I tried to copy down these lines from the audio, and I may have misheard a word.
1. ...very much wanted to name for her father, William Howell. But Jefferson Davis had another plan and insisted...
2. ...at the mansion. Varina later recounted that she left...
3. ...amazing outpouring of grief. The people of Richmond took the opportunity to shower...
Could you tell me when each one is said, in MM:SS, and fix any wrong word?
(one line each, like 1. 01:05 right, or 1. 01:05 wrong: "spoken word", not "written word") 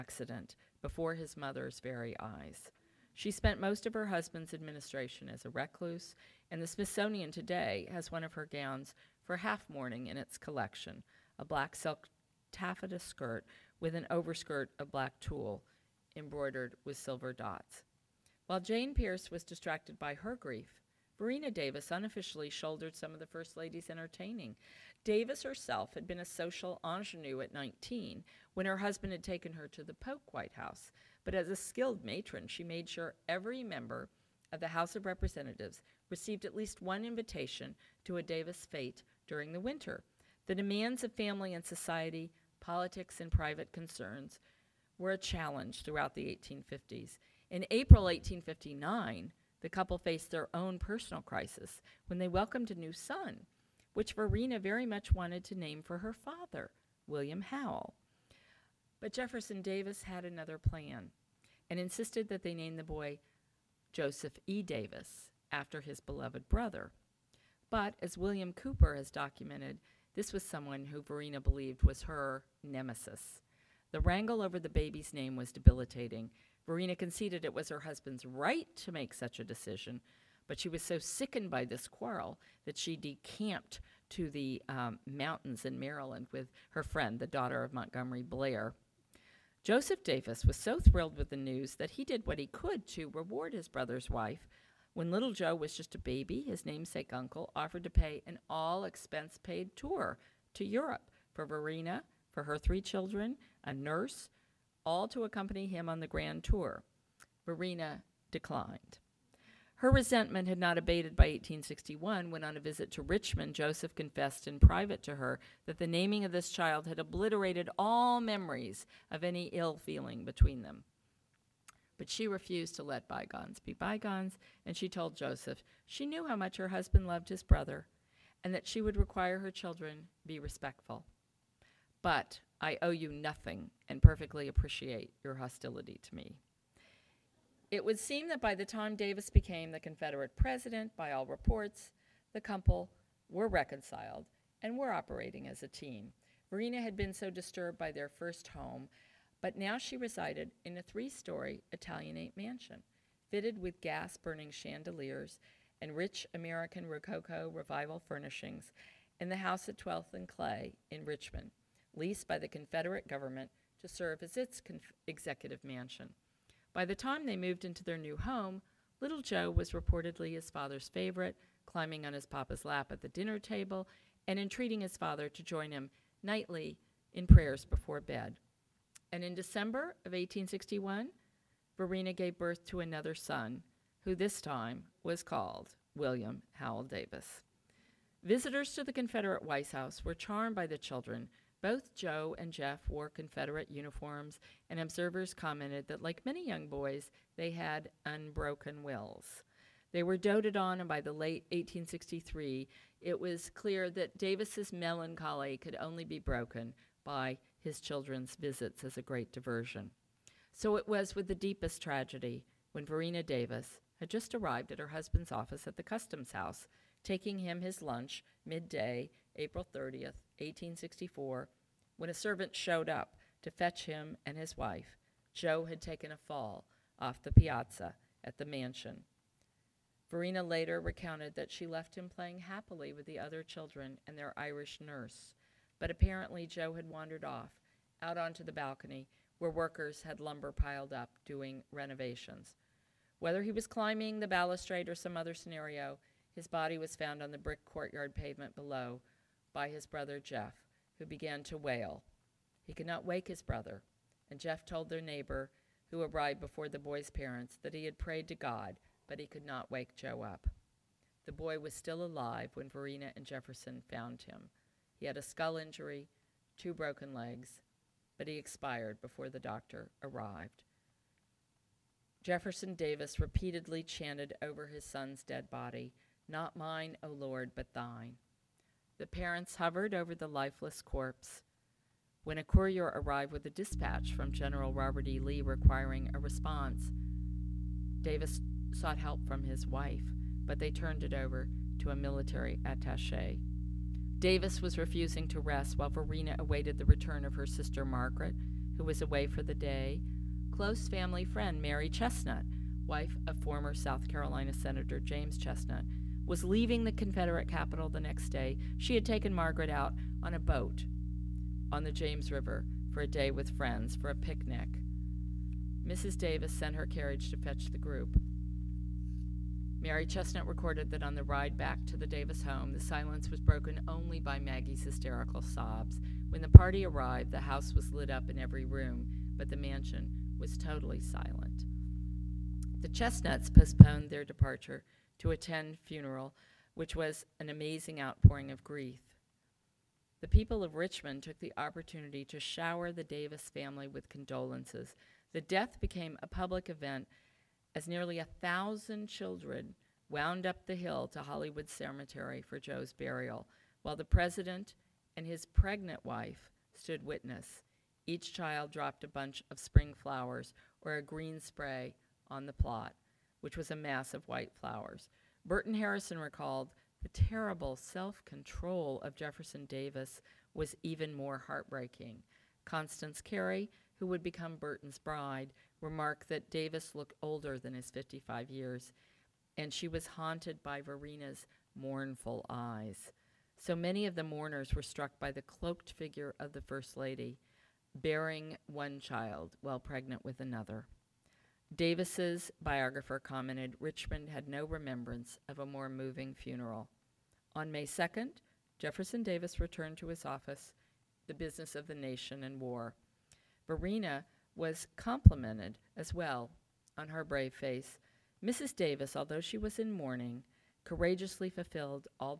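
1. 00:54 right
2. 03:48 right
3. 05:37 right.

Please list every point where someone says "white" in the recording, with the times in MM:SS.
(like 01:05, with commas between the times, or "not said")
00:30, 03:09, 06:04.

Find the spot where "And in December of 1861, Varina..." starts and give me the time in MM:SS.
02:59.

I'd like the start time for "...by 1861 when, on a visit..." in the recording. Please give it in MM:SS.
01:51.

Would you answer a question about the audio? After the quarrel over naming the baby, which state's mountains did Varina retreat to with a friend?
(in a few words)
Maryland.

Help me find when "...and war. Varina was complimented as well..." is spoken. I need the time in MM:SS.
06:42.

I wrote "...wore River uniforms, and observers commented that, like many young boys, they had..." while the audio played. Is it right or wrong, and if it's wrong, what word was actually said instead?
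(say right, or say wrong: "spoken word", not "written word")
wrong: "Confederate", not "River".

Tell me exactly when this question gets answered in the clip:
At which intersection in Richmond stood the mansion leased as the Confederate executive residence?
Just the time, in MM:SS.
02:39.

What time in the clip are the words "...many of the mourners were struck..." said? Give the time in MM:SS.
06:23.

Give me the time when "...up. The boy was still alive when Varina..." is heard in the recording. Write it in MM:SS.
04:20.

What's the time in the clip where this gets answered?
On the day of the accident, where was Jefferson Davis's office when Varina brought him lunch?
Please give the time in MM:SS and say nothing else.
03:35.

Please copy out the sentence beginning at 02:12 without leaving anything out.
But I owe you nothing and perfectly appreciate your hostility to me.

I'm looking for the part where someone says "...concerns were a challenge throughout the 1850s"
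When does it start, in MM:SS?
00:43.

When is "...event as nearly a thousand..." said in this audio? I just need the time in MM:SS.
05:46.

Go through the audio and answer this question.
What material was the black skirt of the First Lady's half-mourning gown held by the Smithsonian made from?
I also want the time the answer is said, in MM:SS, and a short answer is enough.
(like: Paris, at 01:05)
Silk taffeta, at 00:11.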